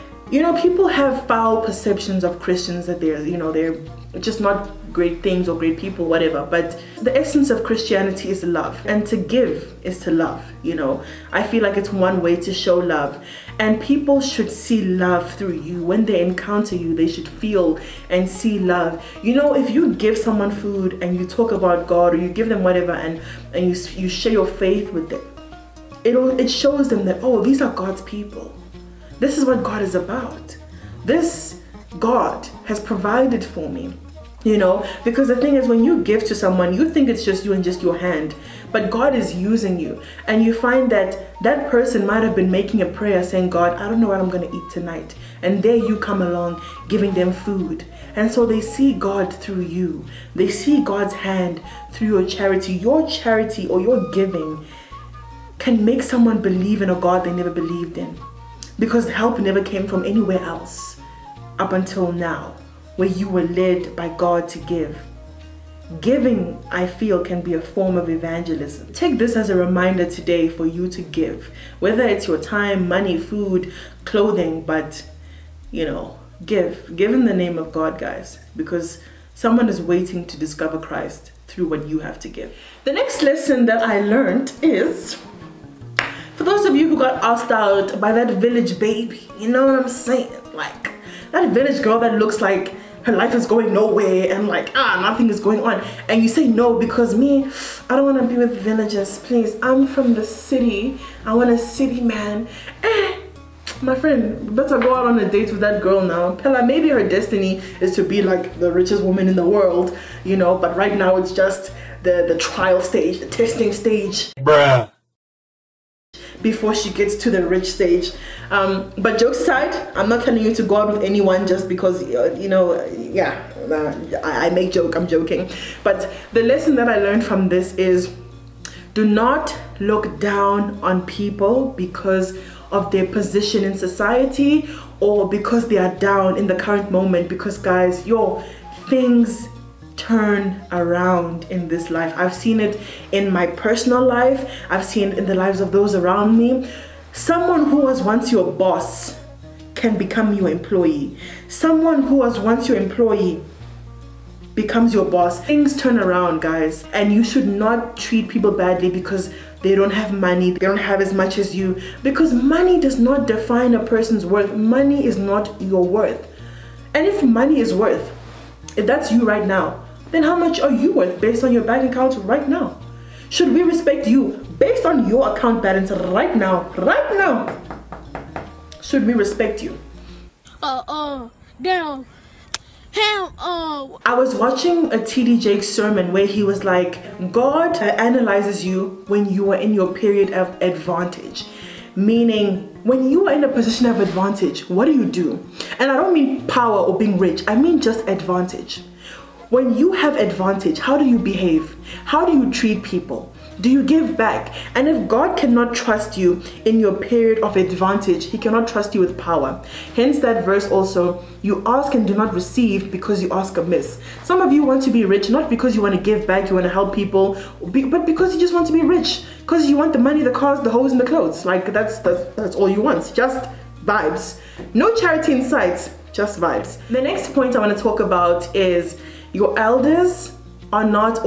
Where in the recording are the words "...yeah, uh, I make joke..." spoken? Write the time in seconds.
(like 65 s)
122 s.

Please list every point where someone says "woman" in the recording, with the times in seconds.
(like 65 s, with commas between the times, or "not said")
109 s.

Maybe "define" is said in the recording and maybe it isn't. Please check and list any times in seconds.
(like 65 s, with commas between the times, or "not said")
163 s.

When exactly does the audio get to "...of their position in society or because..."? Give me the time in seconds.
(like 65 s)
132 s.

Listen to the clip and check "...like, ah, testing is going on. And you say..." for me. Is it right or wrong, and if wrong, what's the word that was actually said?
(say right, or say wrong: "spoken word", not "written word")
wrong: "nothing", not "testing".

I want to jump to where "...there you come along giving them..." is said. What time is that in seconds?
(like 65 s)
45 s.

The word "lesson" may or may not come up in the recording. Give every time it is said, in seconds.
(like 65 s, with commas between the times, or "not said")
83 s, 126 s.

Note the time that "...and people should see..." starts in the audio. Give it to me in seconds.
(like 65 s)
13 s.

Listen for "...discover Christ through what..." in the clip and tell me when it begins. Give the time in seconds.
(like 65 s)
80 s.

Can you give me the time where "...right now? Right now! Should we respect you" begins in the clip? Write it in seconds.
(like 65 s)
175 s.